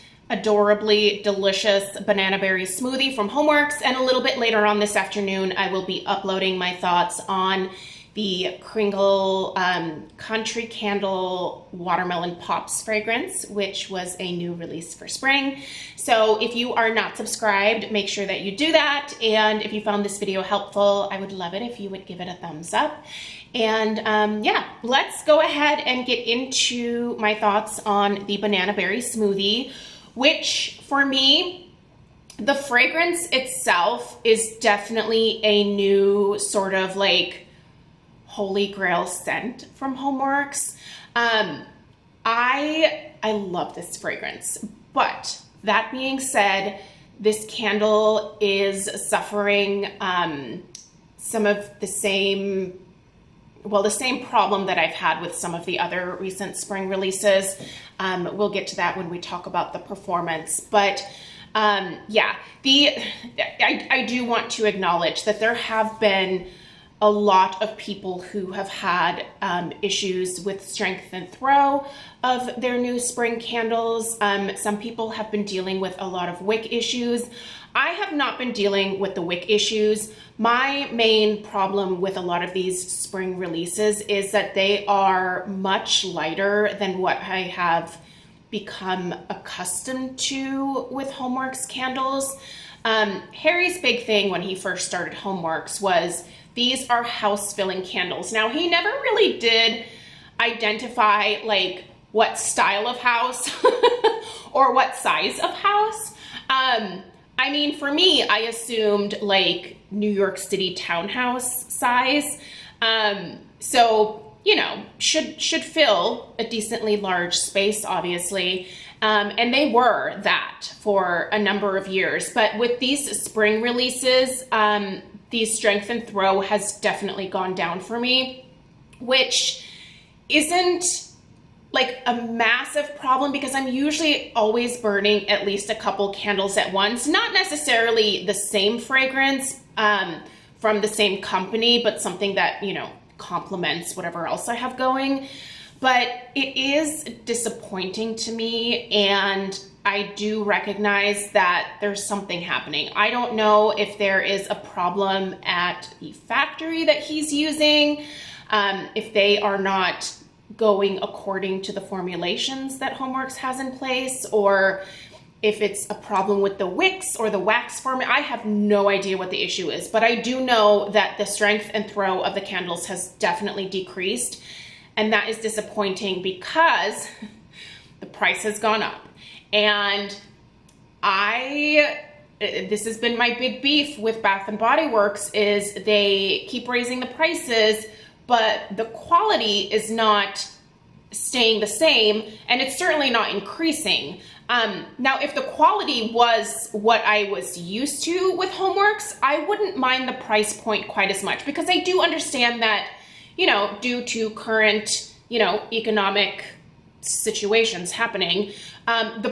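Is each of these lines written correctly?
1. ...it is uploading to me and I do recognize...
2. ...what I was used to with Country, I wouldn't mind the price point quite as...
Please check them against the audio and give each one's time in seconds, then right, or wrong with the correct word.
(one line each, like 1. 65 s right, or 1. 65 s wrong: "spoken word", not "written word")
1. 146 s wrong: "disappointing", not "uploading"
2. 196 s wrong: "HomeWorx", not "Country".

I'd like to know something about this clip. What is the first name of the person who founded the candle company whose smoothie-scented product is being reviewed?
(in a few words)
Harry.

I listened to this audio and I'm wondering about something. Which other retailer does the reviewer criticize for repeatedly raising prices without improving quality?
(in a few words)
Bath and Body Works.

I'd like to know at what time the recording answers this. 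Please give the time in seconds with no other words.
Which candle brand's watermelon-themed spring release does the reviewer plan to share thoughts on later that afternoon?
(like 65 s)
10 s.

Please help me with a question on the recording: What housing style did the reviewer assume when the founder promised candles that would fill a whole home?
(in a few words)
New York City townhouse.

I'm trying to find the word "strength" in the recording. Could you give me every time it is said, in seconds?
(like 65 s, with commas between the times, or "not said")
70 s, 125 s, 171 s.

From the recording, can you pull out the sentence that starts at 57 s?
Um, we'll get to that when we talk about the performance.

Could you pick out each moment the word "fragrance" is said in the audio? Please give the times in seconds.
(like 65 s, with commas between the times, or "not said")
12 s, 32 s, 43 s, 138 s.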